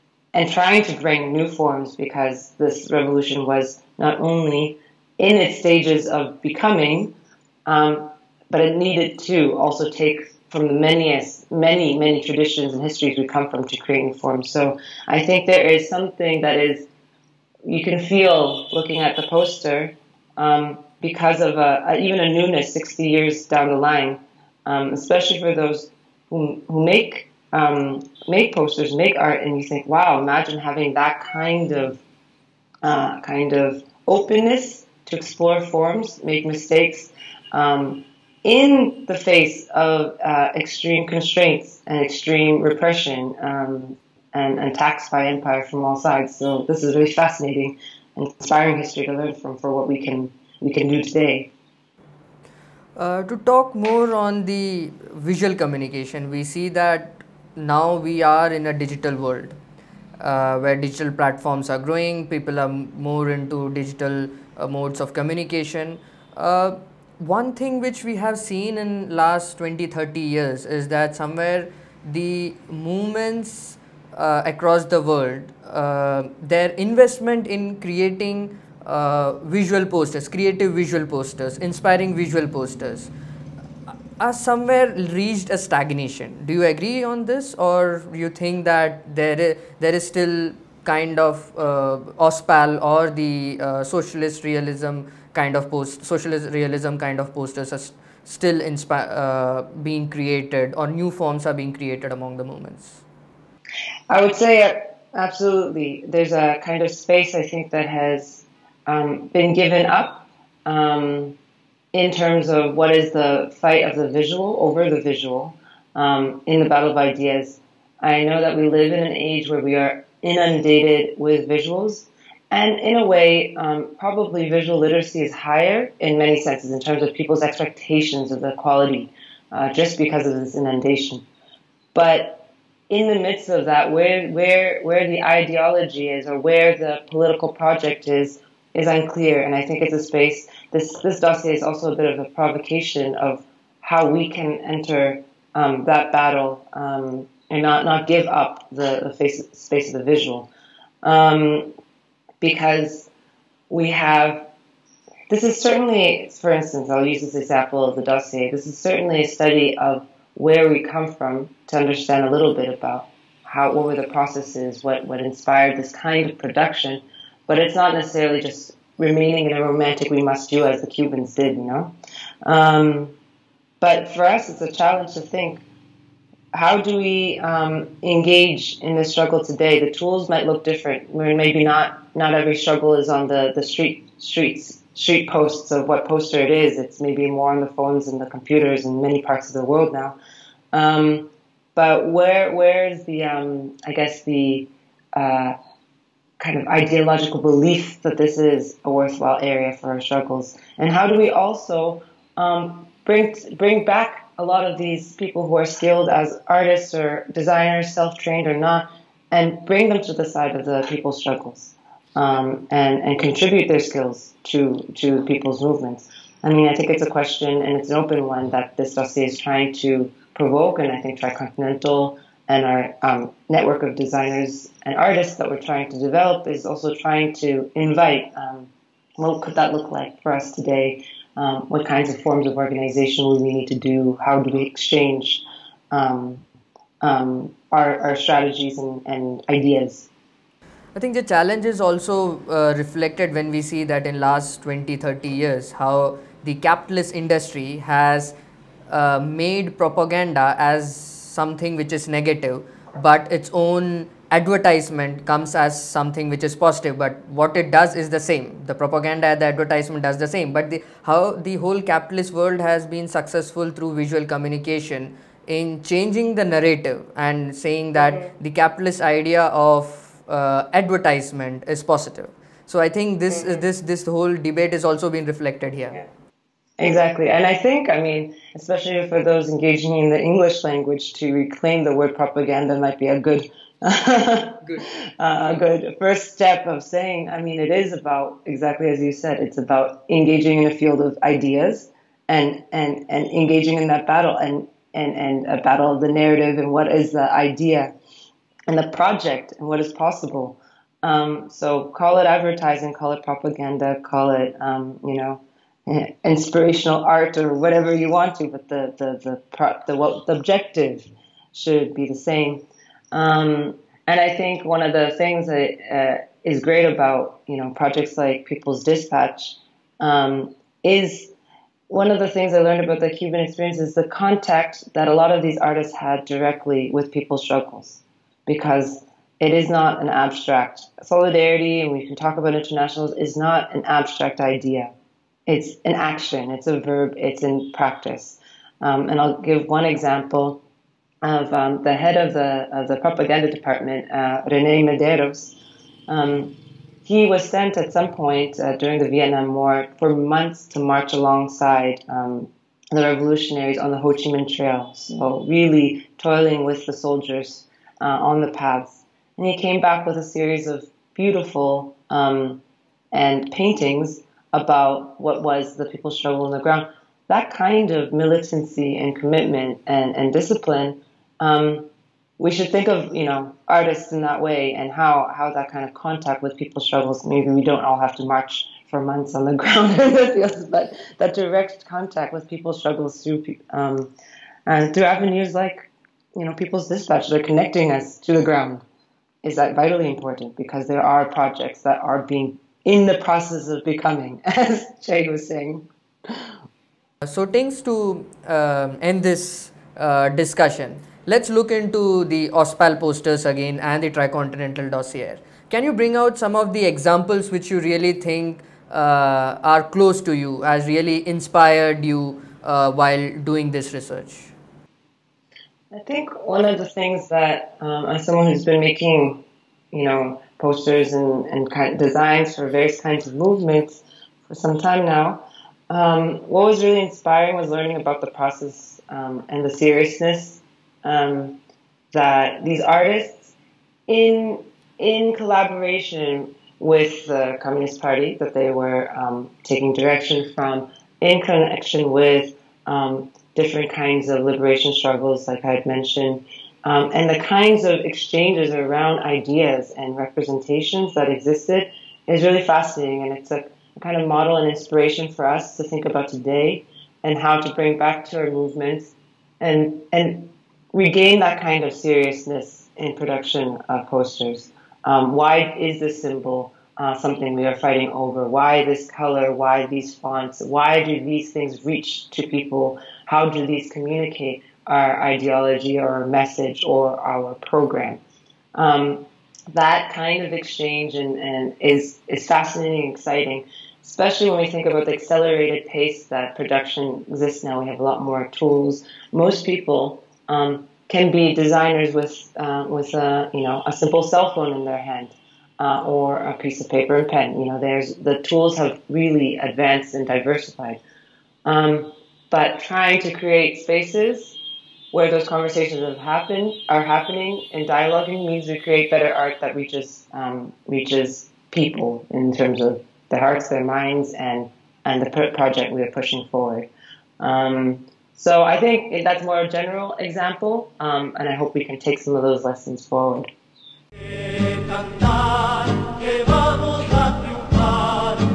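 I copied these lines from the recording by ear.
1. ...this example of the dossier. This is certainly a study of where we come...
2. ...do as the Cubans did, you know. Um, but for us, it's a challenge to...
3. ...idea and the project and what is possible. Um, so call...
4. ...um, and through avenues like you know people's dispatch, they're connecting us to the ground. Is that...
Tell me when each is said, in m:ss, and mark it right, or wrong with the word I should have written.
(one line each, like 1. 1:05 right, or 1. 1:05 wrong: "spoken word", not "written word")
1. 2:37 right
2. 2:50 right
3. 4:57 right
4. 6:23 right.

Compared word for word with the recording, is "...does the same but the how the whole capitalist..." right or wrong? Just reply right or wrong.
right.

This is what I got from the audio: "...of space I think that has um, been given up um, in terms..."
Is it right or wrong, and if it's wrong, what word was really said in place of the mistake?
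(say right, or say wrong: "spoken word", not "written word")
right.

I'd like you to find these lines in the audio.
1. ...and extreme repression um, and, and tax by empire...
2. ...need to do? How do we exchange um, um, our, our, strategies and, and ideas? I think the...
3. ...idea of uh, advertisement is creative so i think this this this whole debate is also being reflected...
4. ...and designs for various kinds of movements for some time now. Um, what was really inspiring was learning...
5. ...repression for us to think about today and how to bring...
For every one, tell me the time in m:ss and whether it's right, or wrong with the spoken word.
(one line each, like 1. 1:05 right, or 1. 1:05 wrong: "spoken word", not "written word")
1. 0:41 right
2. 3:53 right
3. 4:29 wrong: "positive", not "creative"
4. 7:01 right
5. 7:34 wrong: "inspiration", not "repression".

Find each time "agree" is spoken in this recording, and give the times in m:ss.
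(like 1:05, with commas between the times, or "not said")
1:26.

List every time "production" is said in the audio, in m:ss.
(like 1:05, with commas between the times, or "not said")
2:46, 7:43, 8:06.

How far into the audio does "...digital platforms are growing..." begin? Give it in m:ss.
1:00.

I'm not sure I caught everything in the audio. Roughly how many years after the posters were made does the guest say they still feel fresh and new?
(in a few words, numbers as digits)
60 years.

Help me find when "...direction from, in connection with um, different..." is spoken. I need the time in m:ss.
7:19.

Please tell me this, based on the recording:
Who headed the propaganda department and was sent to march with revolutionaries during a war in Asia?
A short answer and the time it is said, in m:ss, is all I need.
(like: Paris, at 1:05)
Rene Mederos, at 5:44.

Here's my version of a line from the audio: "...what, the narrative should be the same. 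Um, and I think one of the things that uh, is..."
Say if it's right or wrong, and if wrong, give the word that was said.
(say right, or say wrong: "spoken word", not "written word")
wrong: "objective", not "narrative".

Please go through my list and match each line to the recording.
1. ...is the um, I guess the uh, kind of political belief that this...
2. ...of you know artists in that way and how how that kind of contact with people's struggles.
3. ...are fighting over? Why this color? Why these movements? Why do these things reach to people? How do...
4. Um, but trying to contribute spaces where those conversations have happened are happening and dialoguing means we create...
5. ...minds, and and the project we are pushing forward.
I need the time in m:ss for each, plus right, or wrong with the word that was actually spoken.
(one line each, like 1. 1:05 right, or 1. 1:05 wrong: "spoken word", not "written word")
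1. 3:12 wrong: "ideological", not "political"
2. 6:12 right
3. 7:47 wrong: "fonts", not "movements"
4. 8:21 wrong: "create", not "contribute"
5. 8:33 right.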